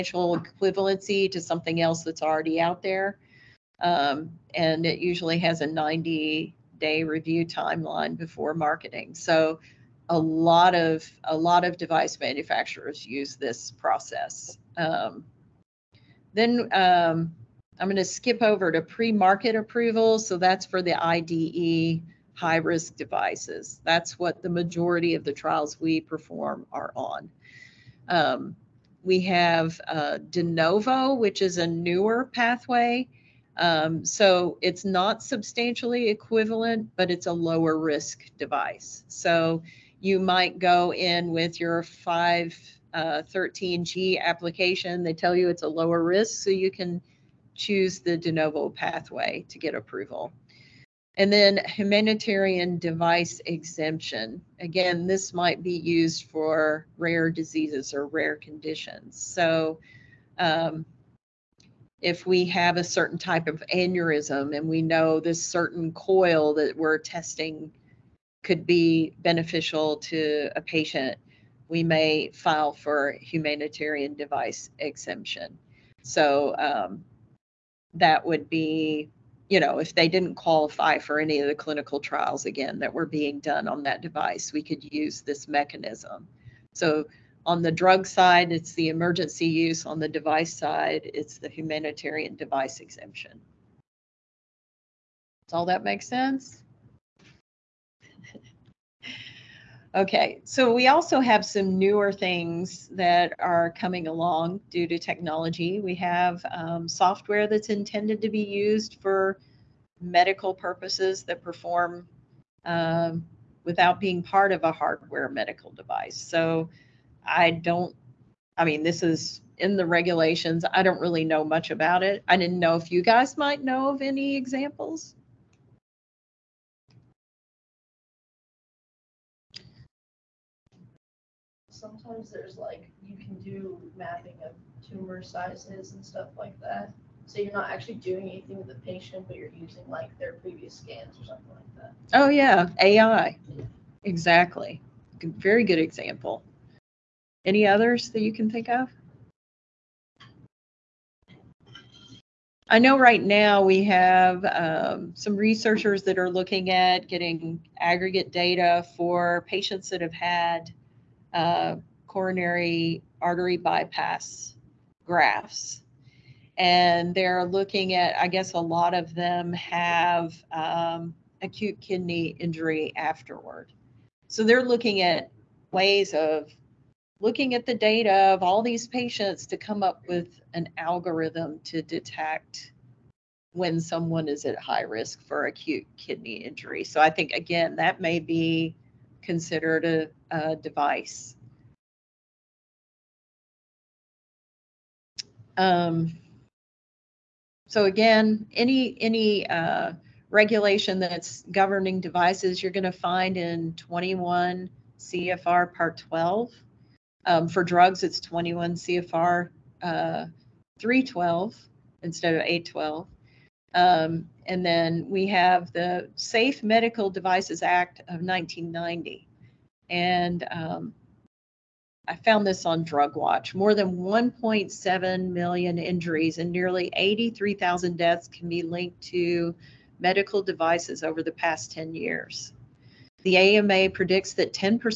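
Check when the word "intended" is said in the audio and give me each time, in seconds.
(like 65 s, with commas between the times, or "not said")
107 s.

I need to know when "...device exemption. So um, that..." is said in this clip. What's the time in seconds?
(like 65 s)
74 s.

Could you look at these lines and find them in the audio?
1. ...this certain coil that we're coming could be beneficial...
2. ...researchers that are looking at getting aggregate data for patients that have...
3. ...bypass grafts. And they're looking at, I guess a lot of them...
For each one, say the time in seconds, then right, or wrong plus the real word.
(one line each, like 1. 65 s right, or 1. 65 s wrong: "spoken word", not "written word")
1. 65 s wrong: "testing", not "coming"
2. 155 s right
3. 163 s right.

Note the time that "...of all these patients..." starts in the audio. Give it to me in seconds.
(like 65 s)
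178 s.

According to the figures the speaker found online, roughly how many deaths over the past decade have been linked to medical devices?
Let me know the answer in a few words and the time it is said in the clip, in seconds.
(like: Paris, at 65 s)
83,000, at 226 s.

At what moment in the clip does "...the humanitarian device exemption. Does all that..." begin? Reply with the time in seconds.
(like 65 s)
91 s.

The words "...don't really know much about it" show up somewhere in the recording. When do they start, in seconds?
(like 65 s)
120 s.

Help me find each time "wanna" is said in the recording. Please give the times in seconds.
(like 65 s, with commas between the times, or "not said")
not said.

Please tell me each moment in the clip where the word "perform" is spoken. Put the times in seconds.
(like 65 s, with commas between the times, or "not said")
26 s, 111 s.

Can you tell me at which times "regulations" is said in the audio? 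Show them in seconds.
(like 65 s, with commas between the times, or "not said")
119 s, 200 s.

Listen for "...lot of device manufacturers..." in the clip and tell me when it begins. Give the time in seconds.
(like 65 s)
11 s.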